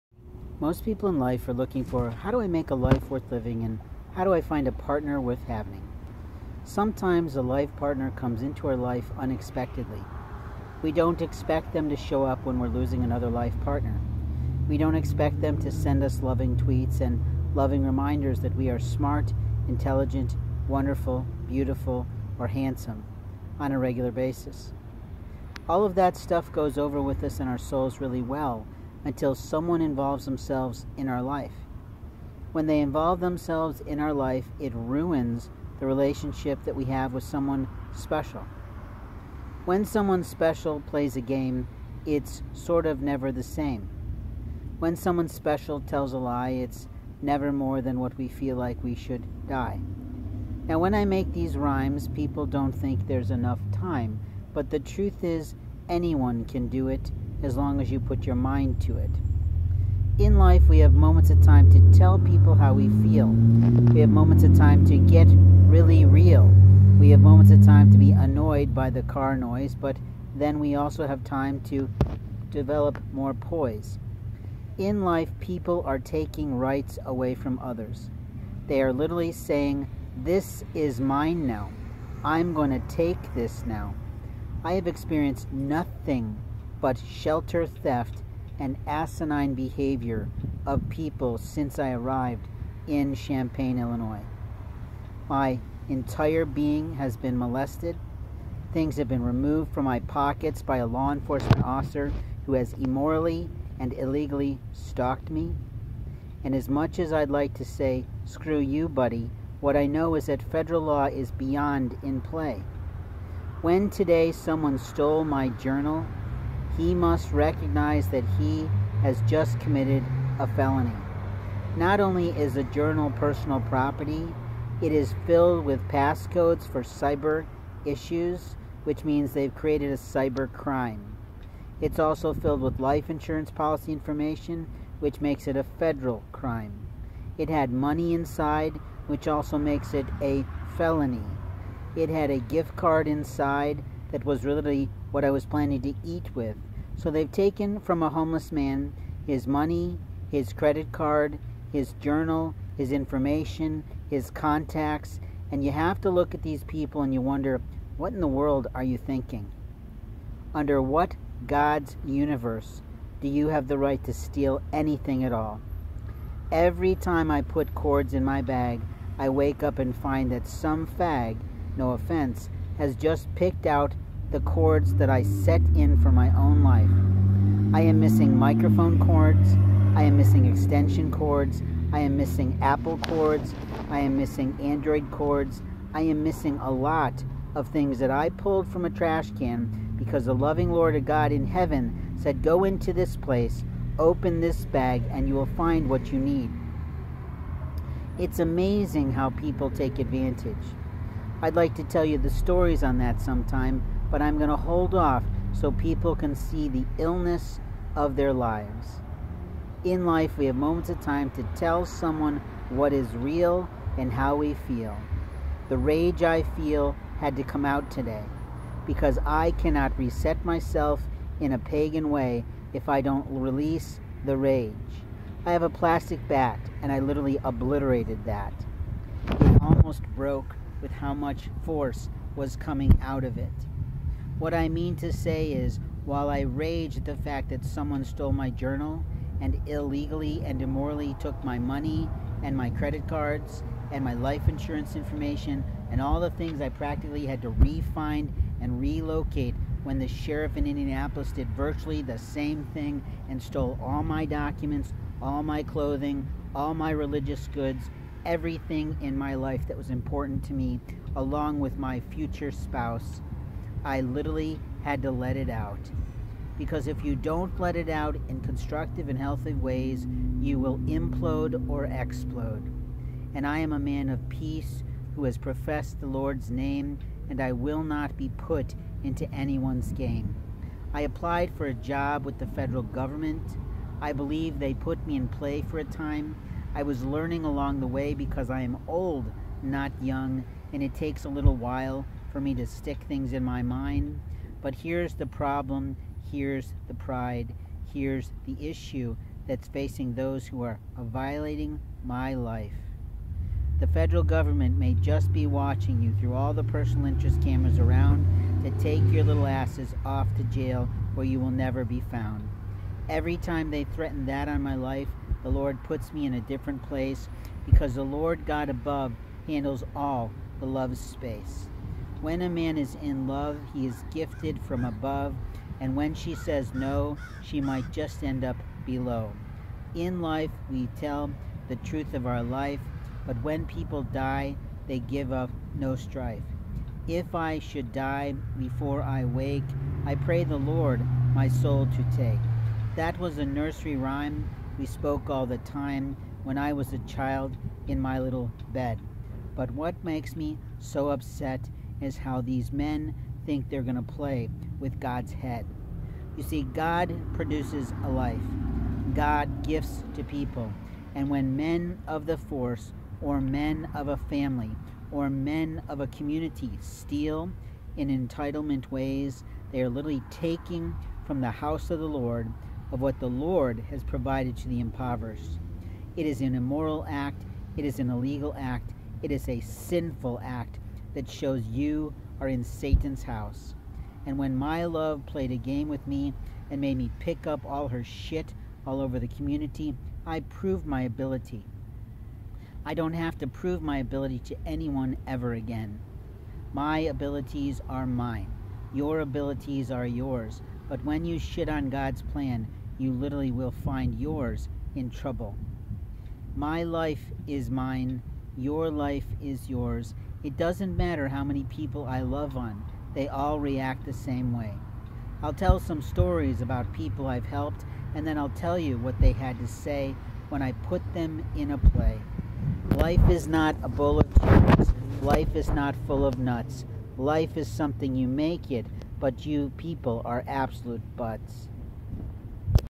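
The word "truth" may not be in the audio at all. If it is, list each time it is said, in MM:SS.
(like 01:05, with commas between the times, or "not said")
00:54, 05:31.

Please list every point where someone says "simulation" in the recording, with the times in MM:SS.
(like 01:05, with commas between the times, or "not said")
not said.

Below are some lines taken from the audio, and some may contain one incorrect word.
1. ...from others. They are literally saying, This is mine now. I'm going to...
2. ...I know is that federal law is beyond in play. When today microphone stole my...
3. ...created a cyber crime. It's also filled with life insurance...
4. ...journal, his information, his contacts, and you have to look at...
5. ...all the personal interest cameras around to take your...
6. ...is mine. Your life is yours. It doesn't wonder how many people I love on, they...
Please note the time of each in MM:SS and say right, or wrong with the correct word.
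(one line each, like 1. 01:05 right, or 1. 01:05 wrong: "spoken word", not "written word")
1. 01:17 right
2. 01:49 wrong: "someone", not "microphone"
3. 02:09 right
4. 02:31 right
5. 05:06 right
6. 06:47 wrong: "matter", not "wonder".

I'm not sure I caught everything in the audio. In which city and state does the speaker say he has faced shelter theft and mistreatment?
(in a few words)
Champaign, Illinois.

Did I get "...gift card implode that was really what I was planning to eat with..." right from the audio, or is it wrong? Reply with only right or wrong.
wrong.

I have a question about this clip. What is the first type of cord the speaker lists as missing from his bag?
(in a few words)
Microphone cords.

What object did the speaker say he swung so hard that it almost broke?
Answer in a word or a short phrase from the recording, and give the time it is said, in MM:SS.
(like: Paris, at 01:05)
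A plastic bat, at 03:45.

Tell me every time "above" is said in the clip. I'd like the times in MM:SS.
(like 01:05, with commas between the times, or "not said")
05:18, 05:24.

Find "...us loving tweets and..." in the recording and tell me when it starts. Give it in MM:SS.
00:16.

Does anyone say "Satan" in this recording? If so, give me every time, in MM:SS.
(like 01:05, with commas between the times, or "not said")
06:22.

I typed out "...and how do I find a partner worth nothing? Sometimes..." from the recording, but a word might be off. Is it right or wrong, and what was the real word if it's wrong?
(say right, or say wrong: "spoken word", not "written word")
wrong: "having", not "nothing".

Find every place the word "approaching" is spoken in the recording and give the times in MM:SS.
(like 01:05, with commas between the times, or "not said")
not said.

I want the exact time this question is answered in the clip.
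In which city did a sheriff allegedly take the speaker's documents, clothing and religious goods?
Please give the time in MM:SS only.
04:10.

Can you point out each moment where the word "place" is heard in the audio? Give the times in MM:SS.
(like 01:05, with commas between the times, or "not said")
03:13, 05:16.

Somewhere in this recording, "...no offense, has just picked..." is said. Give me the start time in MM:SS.
02:51.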